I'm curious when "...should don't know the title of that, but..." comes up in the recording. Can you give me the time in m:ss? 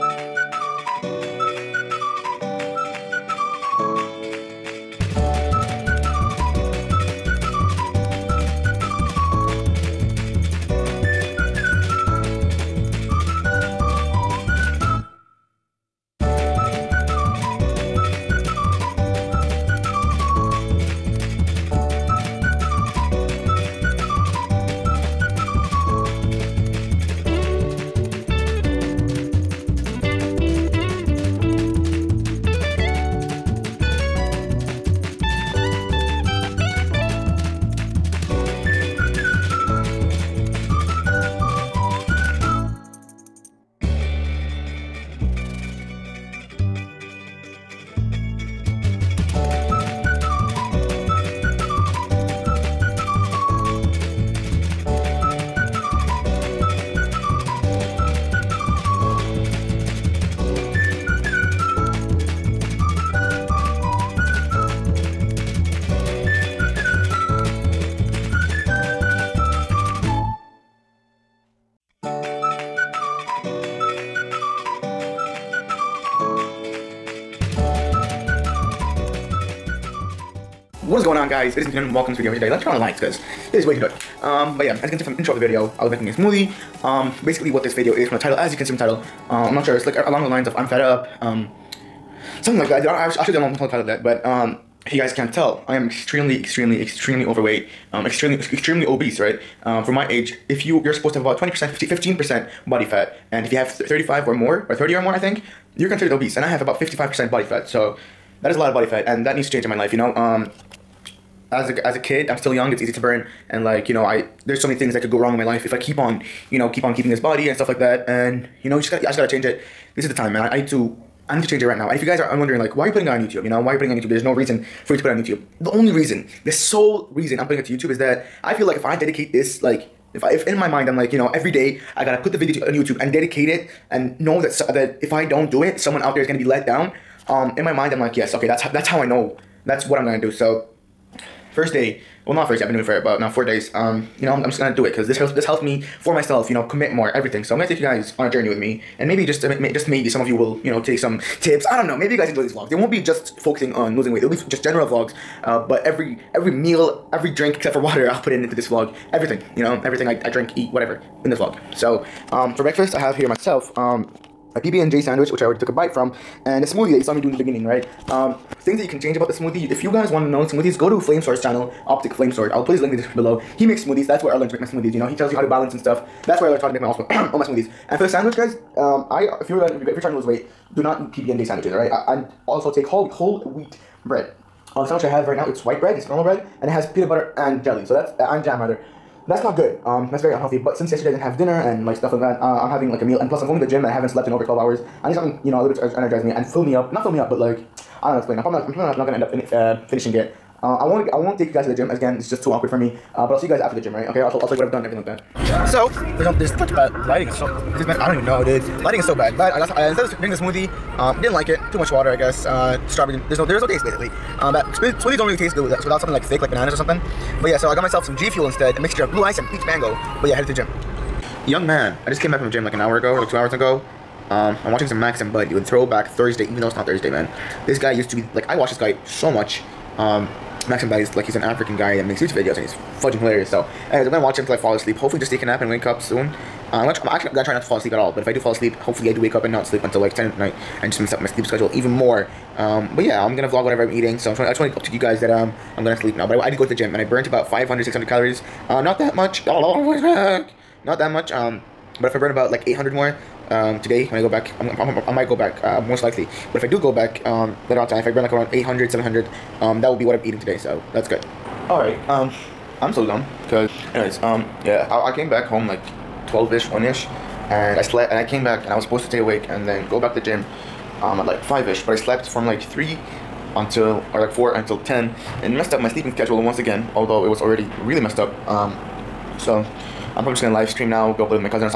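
1:33.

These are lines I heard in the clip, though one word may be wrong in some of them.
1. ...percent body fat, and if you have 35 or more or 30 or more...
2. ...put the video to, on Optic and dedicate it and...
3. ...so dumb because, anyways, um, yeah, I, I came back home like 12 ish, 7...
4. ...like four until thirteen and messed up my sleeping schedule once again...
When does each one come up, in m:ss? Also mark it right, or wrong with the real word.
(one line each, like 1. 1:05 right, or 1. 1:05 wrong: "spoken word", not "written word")
1. 1:42 right
2. 2:12 wrong: "YouTube", not "Optic"
3. 4:22 wrong: "1", not "7"
4. 4:34 wrong: "ten", not "thirteen".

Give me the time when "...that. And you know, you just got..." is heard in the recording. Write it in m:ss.
1:57.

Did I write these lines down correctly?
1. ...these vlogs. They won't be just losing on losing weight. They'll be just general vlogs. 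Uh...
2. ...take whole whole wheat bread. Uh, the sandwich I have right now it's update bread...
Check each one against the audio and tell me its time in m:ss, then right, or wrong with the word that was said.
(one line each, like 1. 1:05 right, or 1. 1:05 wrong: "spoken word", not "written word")
1. 2:32 wrong: "focusing", not "losing"
2. 3:02 wrong: "white", not "update".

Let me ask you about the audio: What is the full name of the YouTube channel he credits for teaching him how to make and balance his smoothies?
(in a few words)
Optic Flame Sword.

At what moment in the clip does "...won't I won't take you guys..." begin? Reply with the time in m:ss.
3:20.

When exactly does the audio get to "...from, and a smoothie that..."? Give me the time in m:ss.
2:45.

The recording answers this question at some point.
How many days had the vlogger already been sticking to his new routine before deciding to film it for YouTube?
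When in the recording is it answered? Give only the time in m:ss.
2:23.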